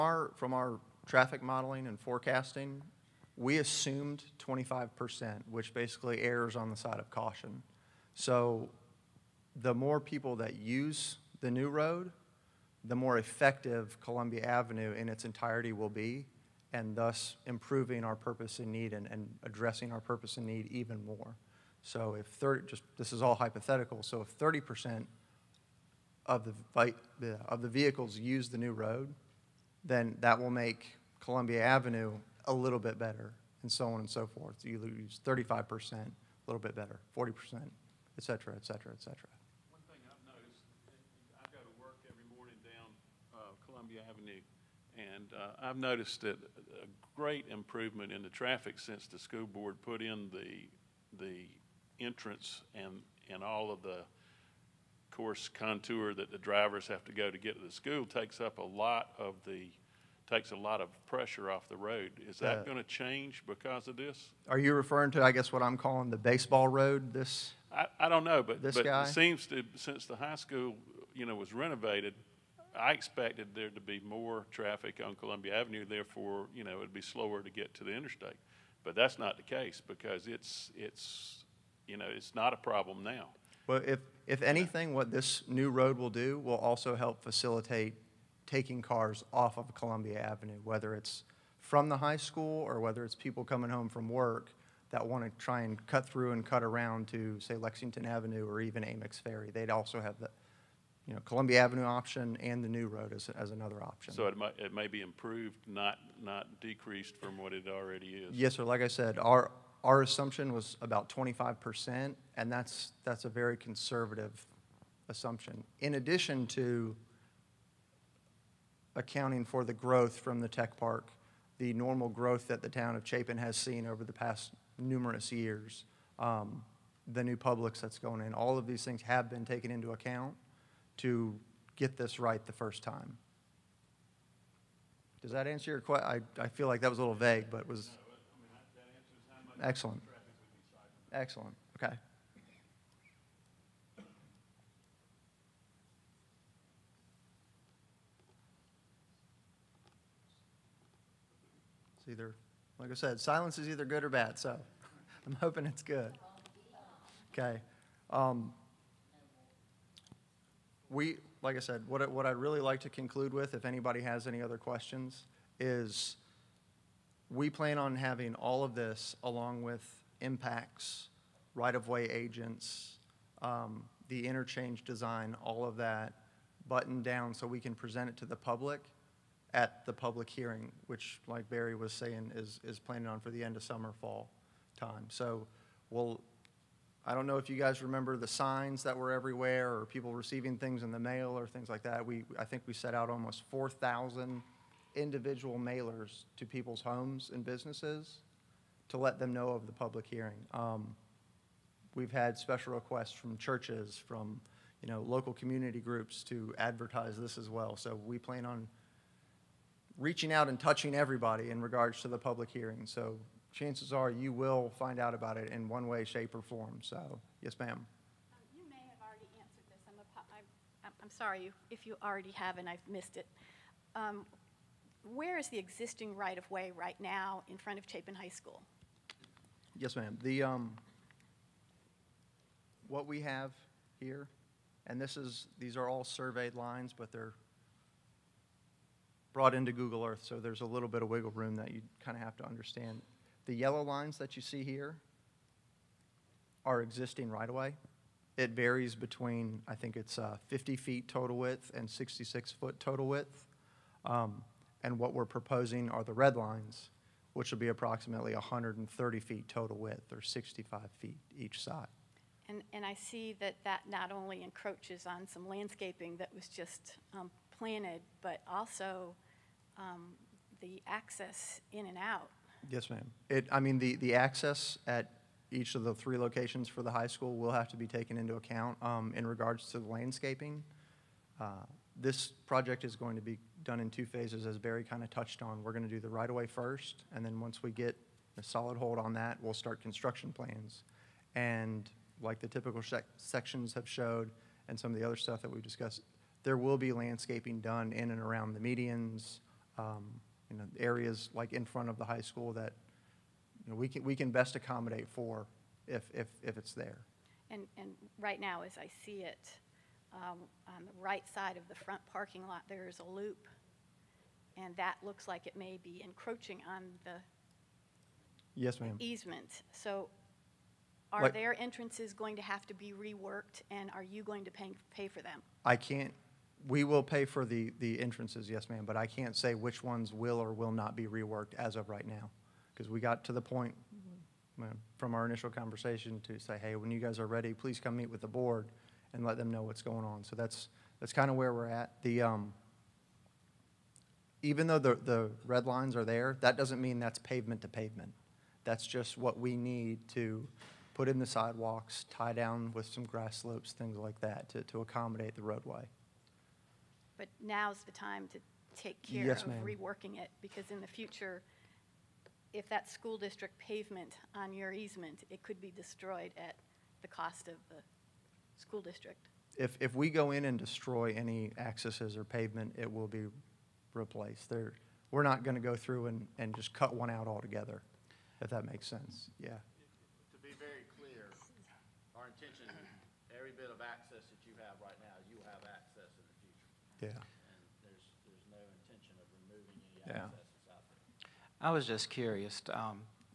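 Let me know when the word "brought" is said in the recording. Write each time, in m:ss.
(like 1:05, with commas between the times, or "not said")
3:59.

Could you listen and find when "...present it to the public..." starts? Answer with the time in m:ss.
2:57.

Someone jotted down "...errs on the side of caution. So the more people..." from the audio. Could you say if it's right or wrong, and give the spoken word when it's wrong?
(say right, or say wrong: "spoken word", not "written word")
right.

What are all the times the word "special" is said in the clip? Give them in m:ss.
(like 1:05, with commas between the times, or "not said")
3:22.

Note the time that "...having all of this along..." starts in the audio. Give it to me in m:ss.
2:47.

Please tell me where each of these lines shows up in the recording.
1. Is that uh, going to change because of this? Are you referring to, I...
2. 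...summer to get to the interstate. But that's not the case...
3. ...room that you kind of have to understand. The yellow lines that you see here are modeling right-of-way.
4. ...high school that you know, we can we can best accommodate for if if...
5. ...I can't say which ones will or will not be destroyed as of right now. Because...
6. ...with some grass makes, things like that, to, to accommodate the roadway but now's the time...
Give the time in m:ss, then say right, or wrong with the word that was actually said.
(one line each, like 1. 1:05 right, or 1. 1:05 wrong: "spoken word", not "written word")
1. 1:02 right
2. 1:17 wrong: "slower", not "summer"
3. 4:01 wrong: "existing", not "modeling"
4. 5:02 right
5. 5:28 wrong: "reworked", not "destroyed"
6. 5:52 wrong: "slopes", not "makes".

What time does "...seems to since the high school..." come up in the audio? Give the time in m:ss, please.
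1:09.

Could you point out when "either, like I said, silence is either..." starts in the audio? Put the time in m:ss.
2:32.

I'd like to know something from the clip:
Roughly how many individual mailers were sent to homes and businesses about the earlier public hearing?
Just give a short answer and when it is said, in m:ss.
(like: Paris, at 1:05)
4,000, at 3:13.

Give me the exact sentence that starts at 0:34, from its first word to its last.
You lose 35%, a little bit better, 40%, et cetera, et cetera, et cetera.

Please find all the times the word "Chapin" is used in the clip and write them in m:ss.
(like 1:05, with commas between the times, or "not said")
2:03, 3:47.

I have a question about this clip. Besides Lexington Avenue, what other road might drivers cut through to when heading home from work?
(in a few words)
Amicks Ferry.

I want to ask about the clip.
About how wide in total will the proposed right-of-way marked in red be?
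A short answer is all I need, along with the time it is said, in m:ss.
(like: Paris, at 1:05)
130 feet, at 4:18.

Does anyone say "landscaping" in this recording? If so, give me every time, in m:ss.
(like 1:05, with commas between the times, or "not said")
4:25, 4:39, 4:56.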